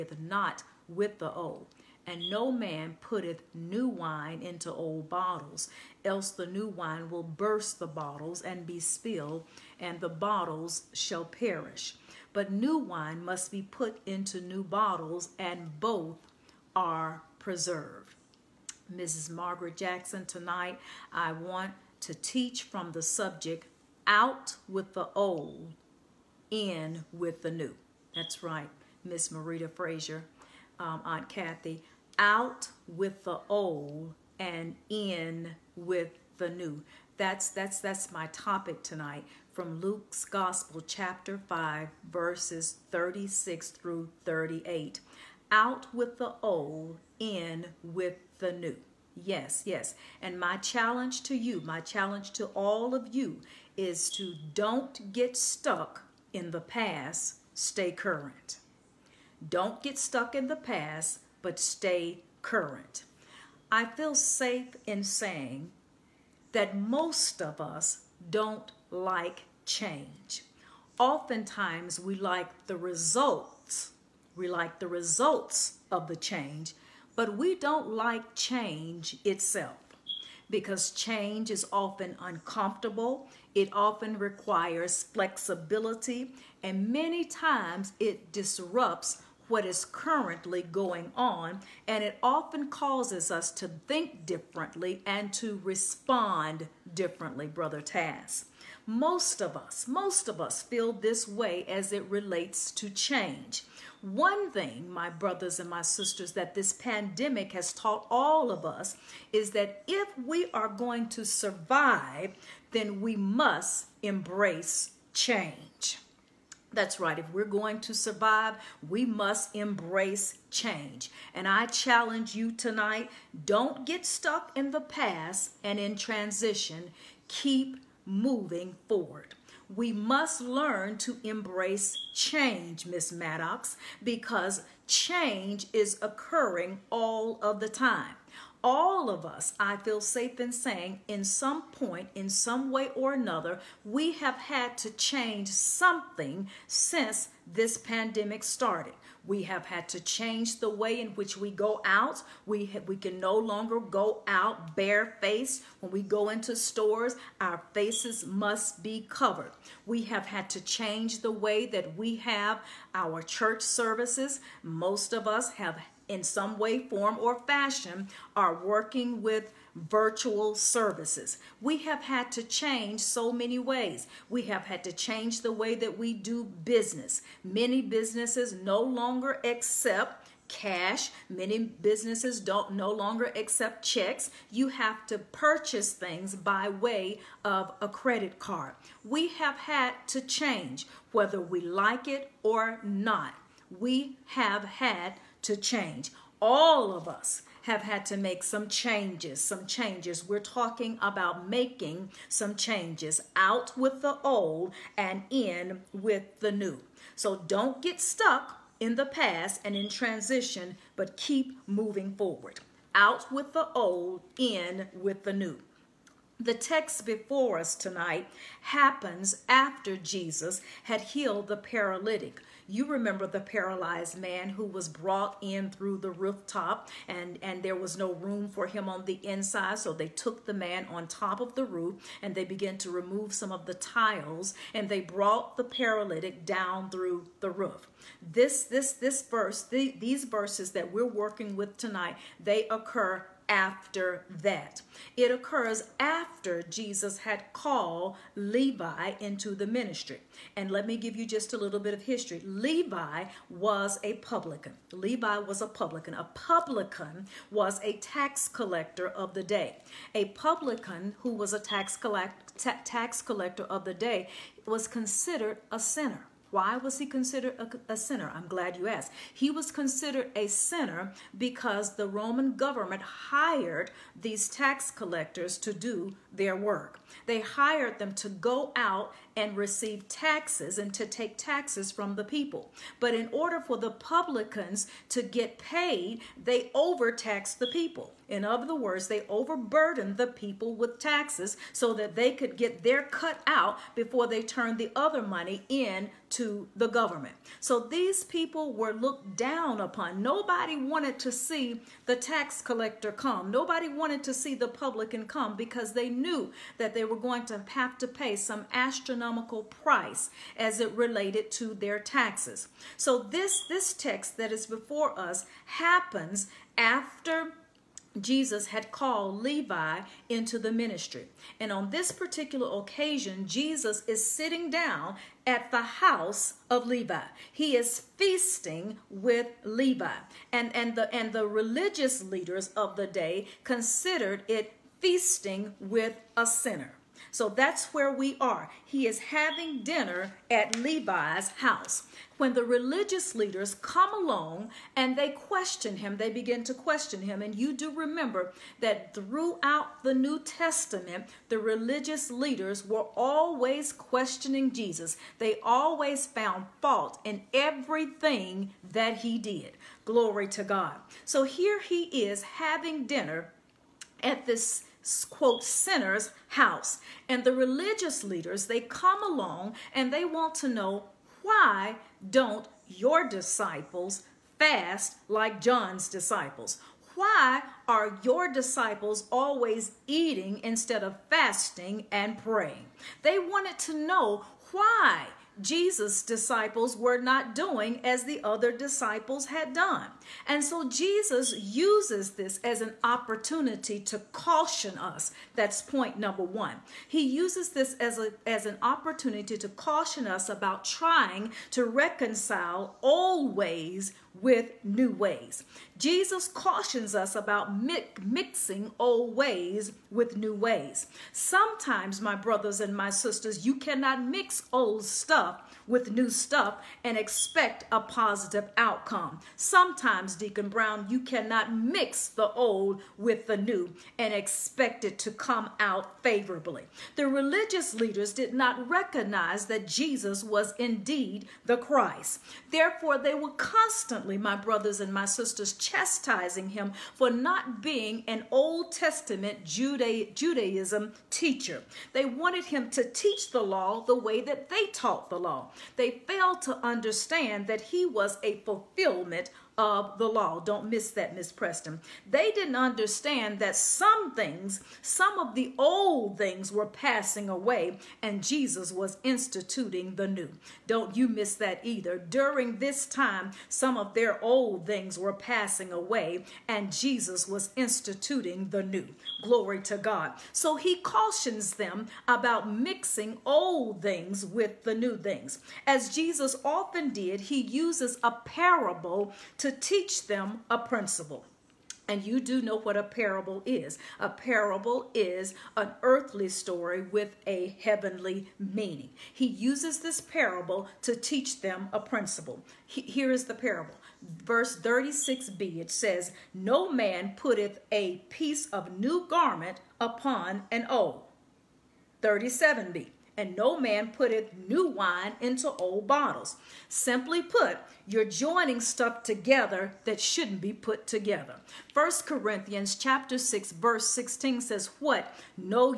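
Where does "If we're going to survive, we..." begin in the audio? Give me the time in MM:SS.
01:57.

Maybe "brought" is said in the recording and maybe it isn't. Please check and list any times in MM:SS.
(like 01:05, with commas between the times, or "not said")
03:44, 03:55.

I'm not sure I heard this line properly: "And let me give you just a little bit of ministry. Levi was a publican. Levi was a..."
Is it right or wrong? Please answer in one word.
wrong.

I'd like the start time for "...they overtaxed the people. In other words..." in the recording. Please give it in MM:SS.
04:46.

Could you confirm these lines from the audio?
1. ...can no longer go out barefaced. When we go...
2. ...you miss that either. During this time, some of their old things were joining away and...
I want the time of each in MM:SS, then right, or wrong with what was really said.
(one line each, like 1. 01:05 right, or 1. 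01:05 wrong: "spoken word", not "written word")
1. 02:32 right
2. 07:41 wrong: "passing", not "joining".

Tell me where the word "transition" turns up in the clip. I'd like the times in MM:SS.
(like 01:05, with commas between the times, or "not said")
02:05, 03:29.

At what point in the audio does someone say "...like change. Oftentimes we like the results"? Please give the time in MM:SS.
01:08.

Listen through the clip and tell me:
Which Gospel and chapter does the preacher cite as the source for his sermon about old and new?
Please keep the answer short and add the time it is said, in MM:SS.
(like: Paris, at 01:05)
Luke chapter 5, at 00:39.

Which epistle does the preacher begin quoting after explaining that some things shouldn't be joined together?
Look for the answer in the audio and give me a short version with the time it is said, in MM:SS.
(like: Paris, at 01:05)
First Corinthians, at 08:31.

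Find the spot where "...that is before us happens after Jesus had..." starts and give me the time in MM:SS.
05:14.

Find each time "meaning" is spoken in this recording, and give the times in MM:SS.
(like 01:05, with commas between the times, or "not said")
08:08.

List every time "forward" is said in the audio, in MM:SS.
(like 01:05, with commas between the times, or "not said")
02:08, 03:32.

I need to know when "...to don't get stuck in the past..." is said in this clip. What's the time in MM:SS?
00:54.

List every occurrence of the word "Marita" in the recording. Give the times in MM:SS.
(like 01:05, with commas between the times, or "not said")
00:29.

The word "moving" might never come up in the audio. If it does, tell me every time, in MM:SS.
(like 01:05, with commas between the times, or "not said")
02:08, 03:31.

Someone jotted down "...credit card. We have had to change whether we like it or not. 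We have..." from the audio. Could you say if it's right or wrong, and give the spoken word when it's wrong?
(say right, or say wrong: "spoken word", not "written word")
right.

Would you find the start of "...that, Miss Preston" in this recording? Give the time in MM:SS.
07:31.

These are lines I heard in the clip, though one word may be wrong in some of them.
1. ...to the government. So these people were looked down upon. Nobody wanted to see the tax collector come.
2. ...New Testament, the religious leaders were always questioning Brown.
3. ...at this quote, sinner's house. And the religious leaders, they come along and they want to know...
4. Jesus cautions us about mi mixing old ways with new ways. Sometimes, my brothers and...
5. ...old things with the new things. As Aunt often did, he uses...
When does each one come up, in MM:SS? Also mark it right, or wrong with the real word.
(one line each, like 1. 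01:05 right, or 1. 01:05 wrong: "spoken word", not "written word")
1. 04:56 right
2. 05:50 wrong: "Jesus", not "Brown"
3. 06:04 right
4. 06:45 right
5. 07:53 wrong: "Jesus", not "Aunt".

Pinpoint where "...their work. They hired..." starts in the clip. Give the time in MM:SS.
04:36.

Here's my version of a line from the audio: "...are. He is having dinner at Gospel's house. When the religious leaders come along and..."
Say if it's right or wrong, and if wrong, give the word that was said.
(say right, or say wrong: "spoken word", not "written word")
wrong: "Levi", not "Gospel".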